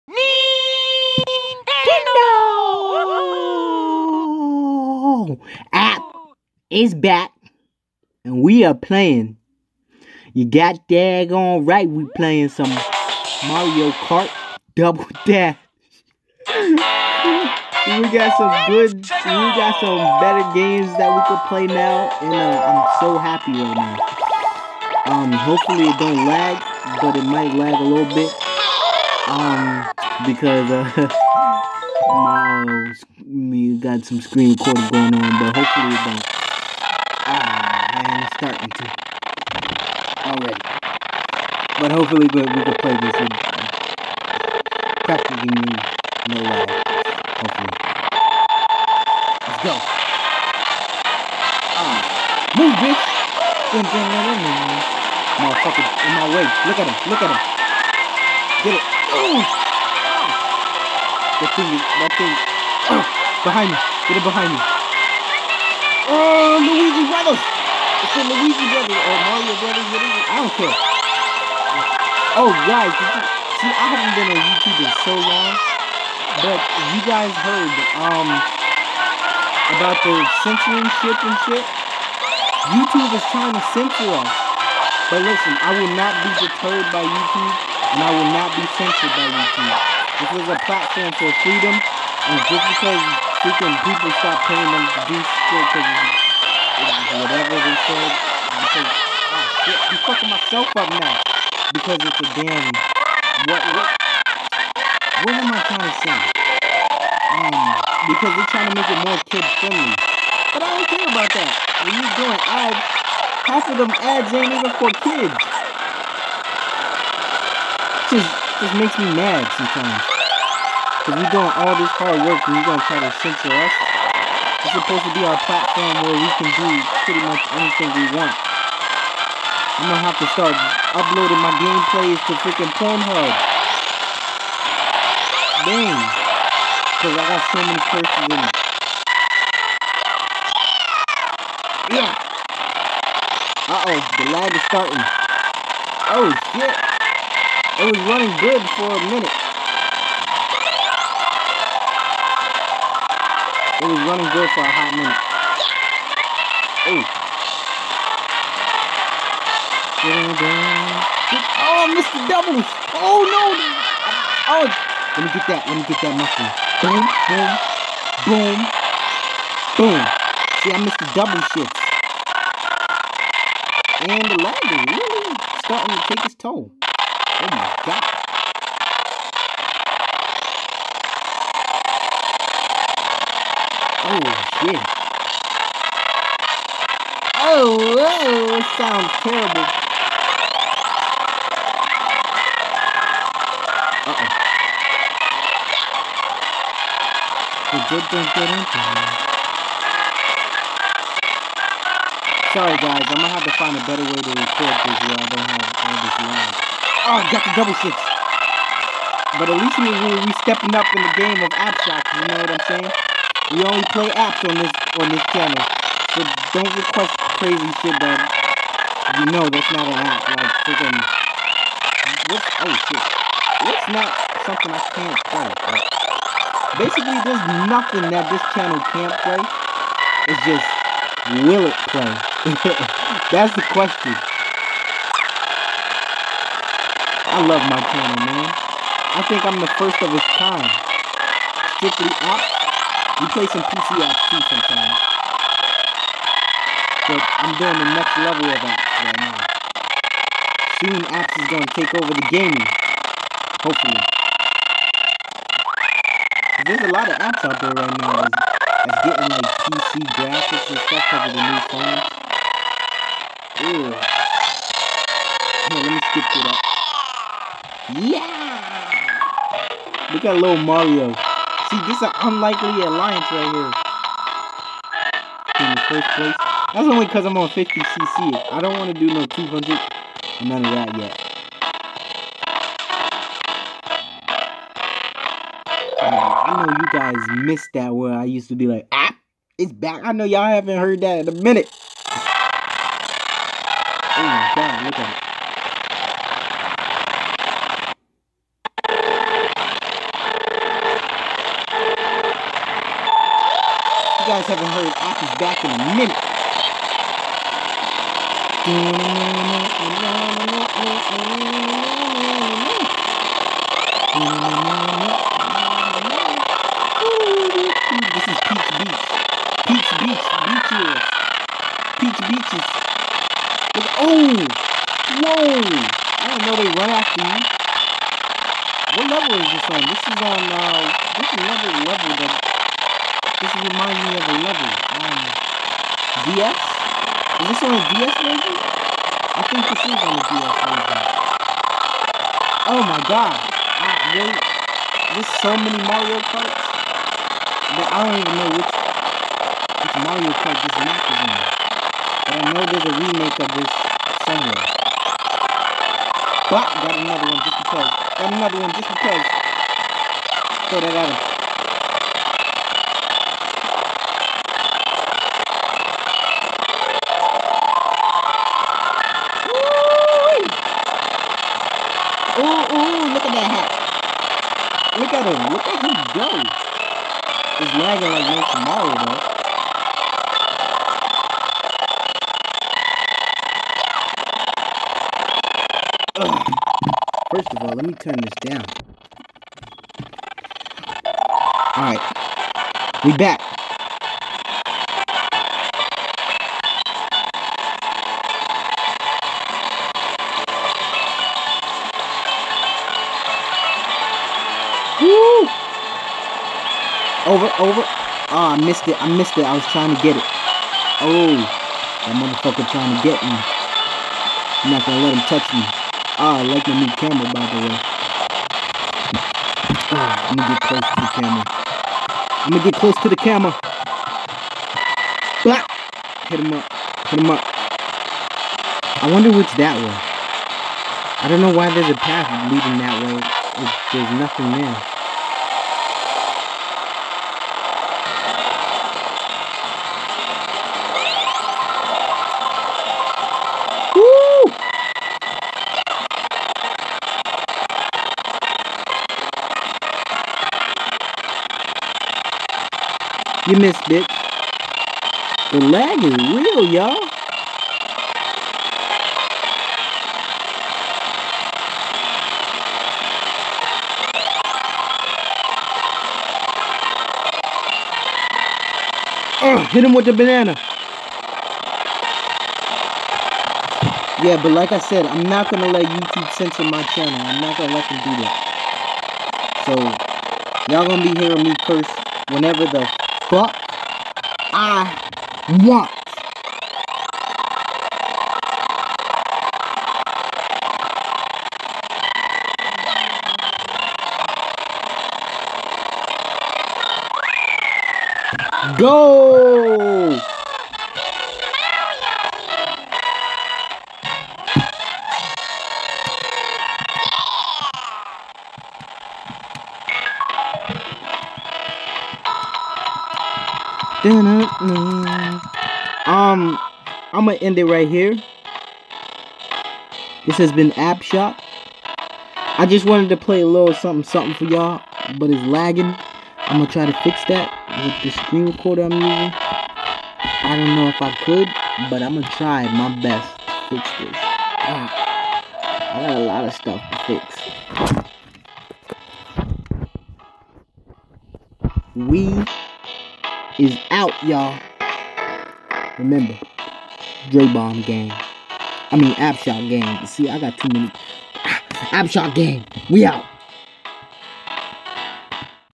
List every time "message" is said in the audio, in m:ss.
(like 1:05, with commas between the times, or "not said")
not said.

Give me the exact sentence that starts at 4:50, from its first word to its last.
I know y'all haven't heard that in a minute.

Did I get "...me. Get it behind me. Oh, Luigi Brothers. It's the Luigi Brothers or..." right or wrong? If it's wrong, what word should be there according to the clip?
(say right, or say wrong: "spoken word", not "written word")
right.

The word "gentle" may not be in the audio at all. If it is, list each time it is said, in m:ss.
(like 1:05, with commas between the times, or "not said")
not said.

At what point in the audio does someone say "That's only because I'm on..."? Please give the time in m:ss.
4:36.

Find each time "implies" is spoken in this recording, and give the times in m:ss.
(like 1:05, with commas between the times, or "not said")
not said.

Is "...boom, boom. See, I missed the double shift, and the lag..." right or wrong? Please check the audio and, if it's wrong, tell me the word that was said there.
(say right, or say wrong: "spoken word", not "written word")
right.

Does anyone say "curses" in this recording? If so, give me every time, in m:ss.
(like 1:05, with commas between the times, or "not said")
2:17, 8:01.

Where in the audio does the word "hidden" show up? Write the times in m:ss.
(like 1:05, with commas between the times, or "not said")
not said.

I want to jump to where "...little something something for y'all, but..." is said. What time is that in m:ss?
8:43.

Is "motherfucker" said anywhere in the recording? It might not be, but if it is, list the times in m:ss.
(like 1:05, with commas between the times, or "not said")
0:55, 6:52.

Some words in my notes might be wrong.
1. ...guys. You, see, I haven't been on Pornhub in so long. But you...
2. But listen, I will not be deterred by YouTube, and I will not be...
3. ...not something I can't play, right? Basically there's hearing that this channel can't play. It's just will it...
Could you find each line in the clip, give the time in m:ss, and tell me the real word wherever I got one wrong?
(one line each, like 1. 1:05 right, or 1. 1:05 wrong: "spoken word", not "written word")
1. 1:12 wrong: "YouTube", not "Pornhub"
2. 1:25 right
3. 3:43 wrong: "nothing", not "hearing".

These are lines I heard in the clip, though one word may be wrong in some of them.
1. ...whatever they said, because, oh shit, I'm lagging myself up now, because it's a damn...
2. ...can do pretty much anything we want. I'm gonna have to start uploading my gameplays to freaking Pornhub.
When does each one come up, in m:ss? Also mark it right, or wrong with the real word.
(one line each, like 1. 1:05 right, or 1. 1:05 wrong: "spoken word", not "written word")
1. 1:37 wrong: "fucking", not "lagging"
2. 2:06 right.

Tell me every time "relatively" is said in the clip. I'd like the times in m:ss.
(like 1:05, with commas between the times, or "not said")
not said.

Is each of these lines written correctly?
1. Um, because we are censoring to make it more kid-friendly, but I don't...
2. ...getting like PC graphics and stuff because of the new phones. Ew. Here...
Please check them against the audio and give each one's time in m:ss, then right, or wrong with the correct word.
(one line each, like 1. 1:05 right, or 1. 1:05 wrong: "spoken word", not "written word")
1. 1:47 wrong: "trying", not "censoring"
2. 4:19 right.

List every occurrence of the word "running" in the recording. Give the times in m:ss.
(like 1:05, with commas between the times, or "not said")
2:28, 2:34.